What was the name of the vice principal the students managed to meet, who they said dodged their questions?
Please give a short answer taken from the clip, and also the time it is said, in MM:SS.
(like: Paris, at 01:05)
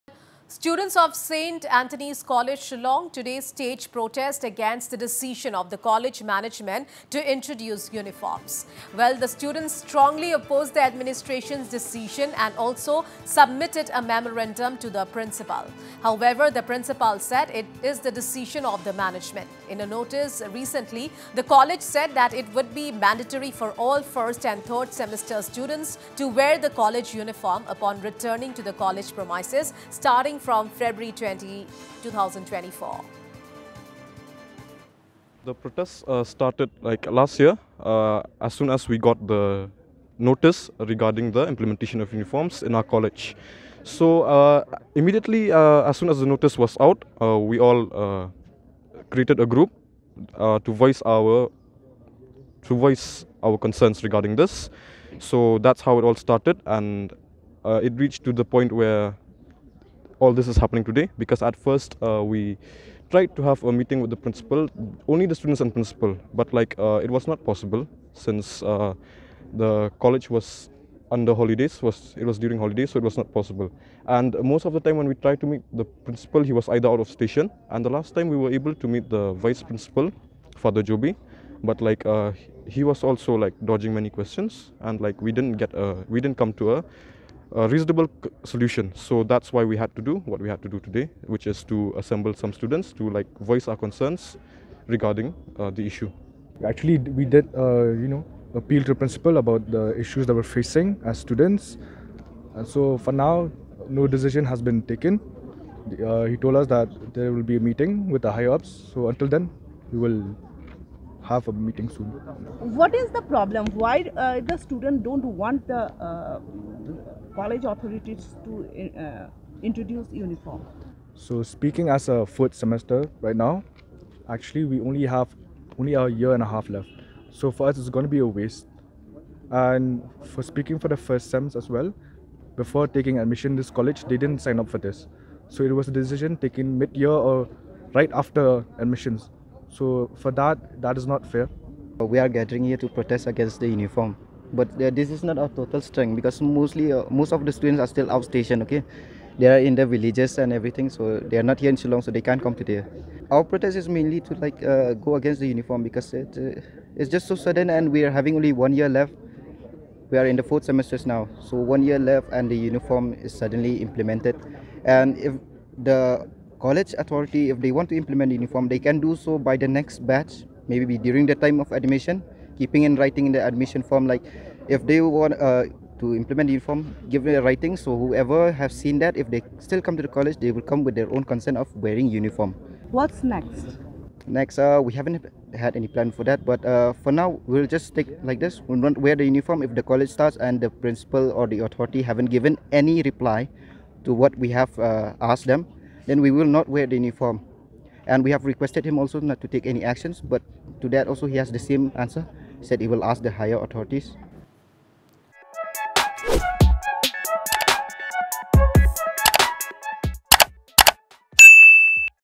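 Father Joby, at 01:20.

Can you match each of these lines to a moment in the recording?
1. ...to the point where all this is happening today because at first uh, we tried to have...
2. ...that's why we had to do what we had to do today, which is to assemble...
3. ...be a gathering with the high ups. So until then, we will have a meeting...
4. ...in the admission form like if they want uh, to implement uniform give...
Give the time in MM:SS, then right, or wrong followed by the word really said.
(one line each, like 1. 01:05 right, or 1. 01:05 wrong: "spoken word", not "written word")
1. 00:58 right
2. 01:29 right
3. 01:47 wrong: "meeting", not "gathering"
4. 02:53 right.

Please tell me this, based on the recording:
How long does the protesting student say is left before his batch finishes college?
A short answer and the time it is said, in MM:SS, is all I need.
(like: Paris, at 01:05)
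a year and a half, at 02:05.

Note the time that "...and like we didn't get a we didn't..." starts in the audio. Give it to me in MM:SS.
01:24.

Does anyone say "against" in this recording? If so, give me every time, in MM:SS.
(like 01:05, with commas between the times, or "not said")
00:04, 02:23, 02:35.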